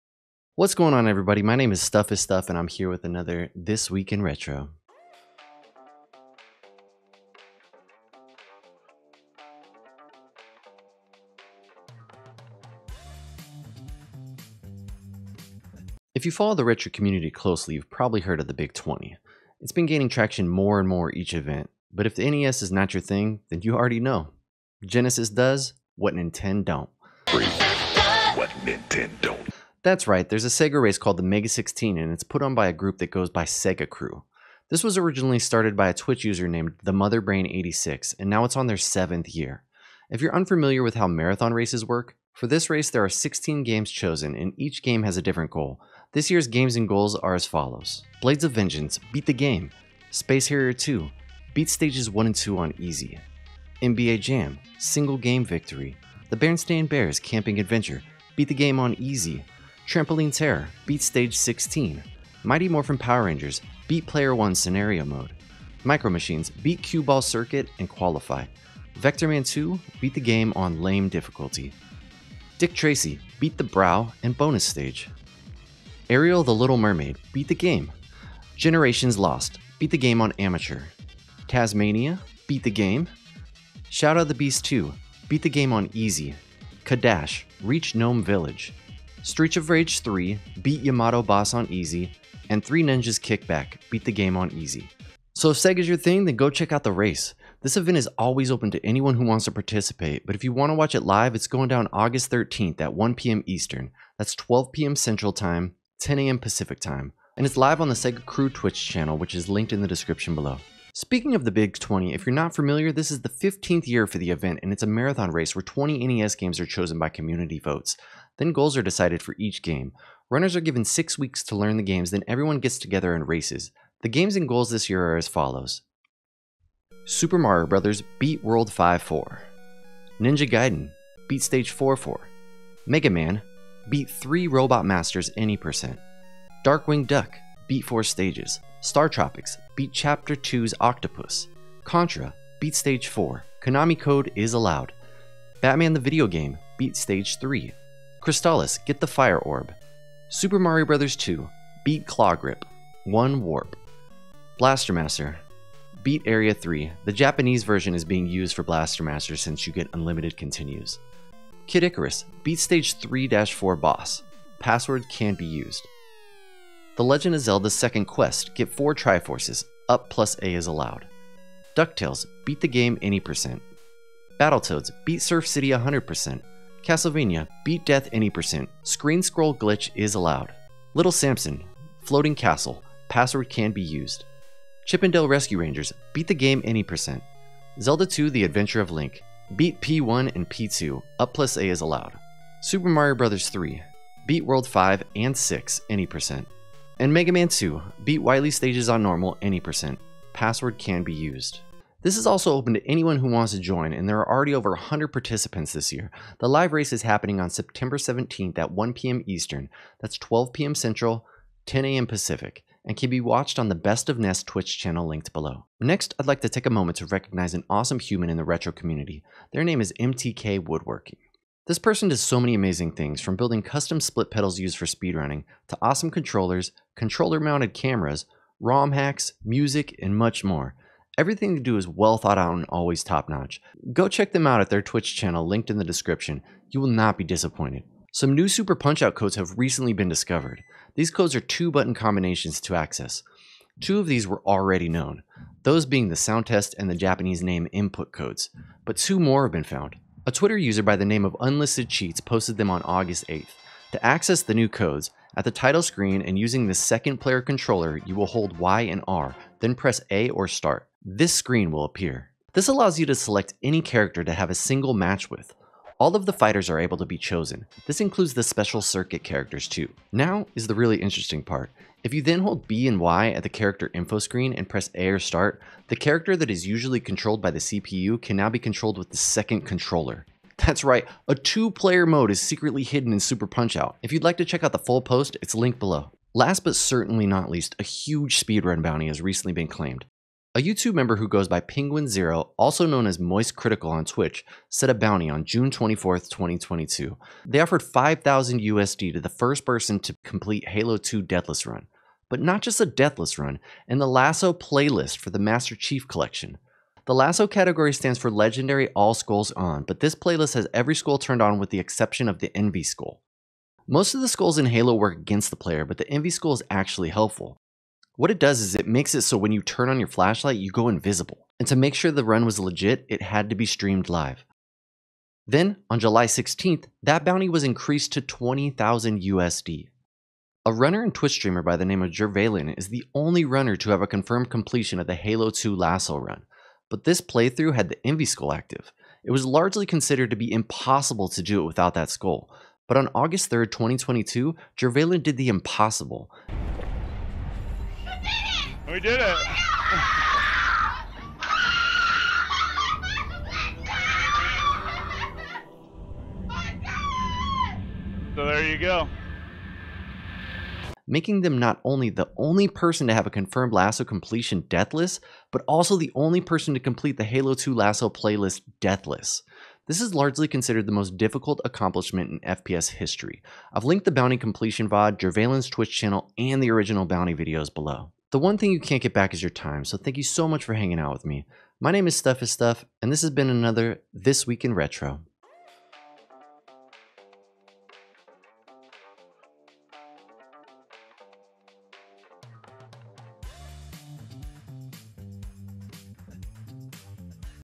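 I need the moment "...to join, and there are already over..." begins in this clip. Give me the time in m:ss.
3:23.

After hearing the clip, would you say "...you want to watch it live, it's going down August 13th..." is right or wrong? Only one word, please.
right.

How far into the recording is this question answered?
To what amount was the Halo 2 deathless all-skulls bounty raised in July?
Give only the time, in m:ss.
5:28.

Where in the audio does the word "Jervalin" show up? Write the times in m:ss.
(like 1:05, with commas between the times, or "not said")
5:32, 5:44, 6:15.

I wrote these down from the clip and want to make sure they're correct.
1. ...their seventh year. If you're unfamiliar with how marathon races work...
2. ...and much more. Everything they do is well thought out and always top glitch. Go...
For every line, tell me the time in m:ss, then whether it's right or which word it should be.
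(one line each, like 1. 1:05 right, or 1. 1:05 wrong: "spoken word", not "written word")
1. 0:38 right
2. 3:50 wrong: "notch", not "glitch".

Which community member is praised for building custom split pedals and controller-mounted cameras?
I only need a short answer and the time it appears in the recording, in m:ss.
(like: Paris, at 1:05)
MTK Woodworking, at 3:39.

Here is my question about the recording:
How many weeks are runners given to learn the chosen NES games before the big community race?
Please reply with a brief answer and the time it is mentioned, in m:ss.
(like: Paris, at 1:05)
6, at 2:00.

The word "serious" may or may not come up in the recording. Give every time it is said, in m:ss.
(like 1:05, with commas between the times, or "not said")
not said.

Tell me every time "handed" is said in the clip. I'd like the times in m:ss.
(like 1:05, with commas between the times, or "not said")
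not said.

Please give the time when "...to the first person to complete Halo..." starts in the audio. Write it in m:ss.
4:59.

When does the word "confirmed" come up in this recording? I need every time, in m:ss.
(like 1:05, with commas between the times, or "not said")
5:34, 6:03.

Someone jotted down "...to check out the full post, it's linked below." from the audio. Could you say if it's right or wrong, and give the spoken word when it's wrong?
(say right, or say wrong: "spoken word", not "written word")
right.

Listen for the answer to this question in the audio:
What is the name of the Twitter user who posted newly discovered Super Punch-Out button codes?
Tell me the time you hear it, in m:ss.
4:11.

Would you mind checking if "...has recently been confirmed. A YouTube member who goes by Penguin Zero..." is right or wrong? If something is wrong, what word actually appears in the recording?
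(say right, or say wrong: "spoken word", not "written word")
wrong: "claimed", not "confirmed".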